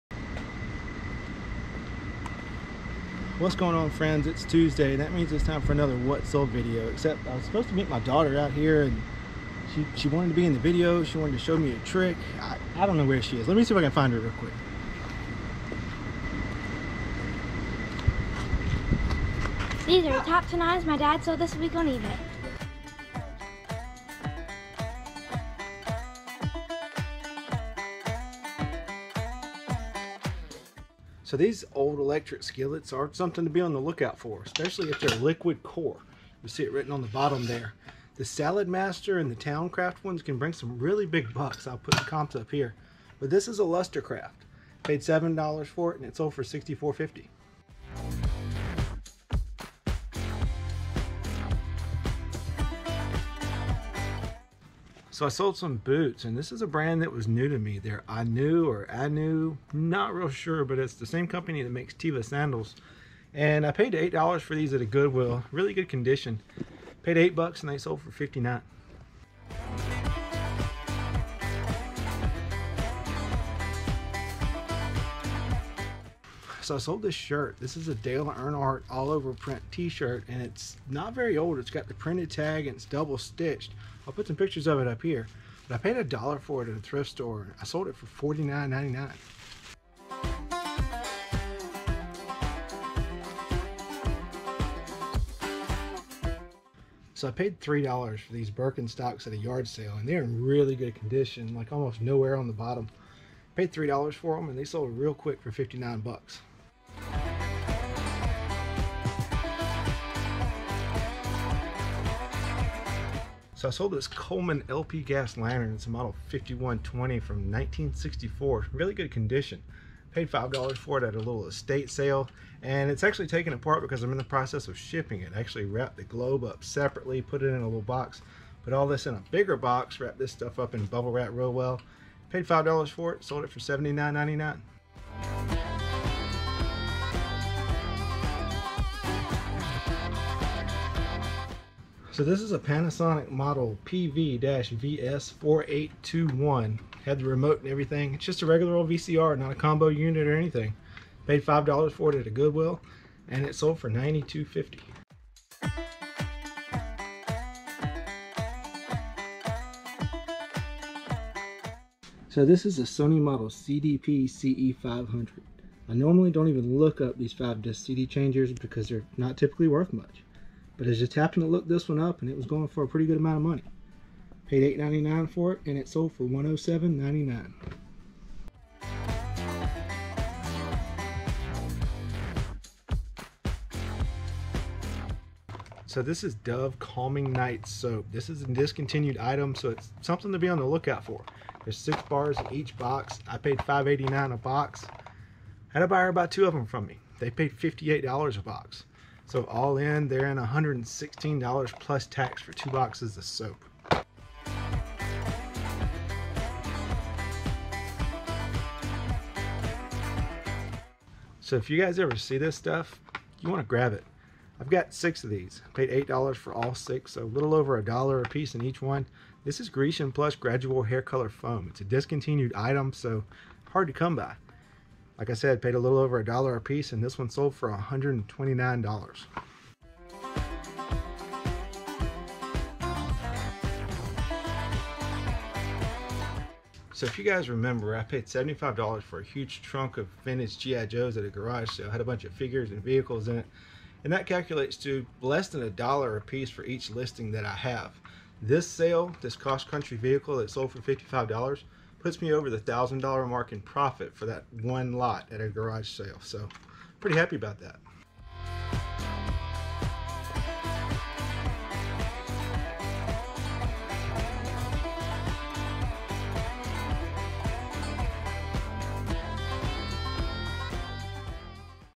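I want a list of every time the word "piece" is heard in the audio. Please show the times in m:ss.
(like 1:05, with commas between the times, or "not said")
3:38, 3:46, 4:06.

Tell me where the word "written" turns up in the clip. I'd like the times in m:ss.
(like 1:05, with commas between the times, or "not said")
0:36.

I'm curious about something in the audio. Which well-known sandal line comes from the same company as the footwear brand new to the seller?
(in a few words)
Teva.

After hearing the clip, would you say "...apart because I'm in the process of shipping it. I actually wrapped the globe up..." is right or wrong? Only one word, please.
right.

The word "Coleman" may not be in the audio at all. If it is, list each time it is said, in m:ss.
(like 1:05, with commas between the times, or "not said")
1:54.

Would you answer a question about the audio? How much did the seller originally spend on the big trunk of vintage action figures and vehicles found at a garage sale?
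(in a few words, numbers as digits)
$75.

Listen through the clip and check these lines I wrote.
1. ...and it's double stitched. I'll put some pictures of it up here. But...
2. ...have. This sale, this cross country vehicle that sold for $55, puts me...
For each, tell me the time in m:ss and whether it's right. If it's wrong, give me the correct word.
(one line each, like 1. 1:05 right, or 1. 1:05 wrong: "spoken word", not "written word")
1. 1:22 right
2. 4:07 right.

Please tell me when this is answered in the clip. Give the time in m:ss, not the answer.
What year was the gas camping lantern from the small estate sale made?
1:57.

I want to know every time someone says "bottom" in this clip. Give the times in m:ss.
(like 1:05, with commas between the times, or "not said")
0:37, 1:42.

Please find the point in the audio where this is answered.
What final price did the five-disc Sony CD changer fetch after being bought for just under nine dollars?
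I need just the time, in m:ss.
2:56.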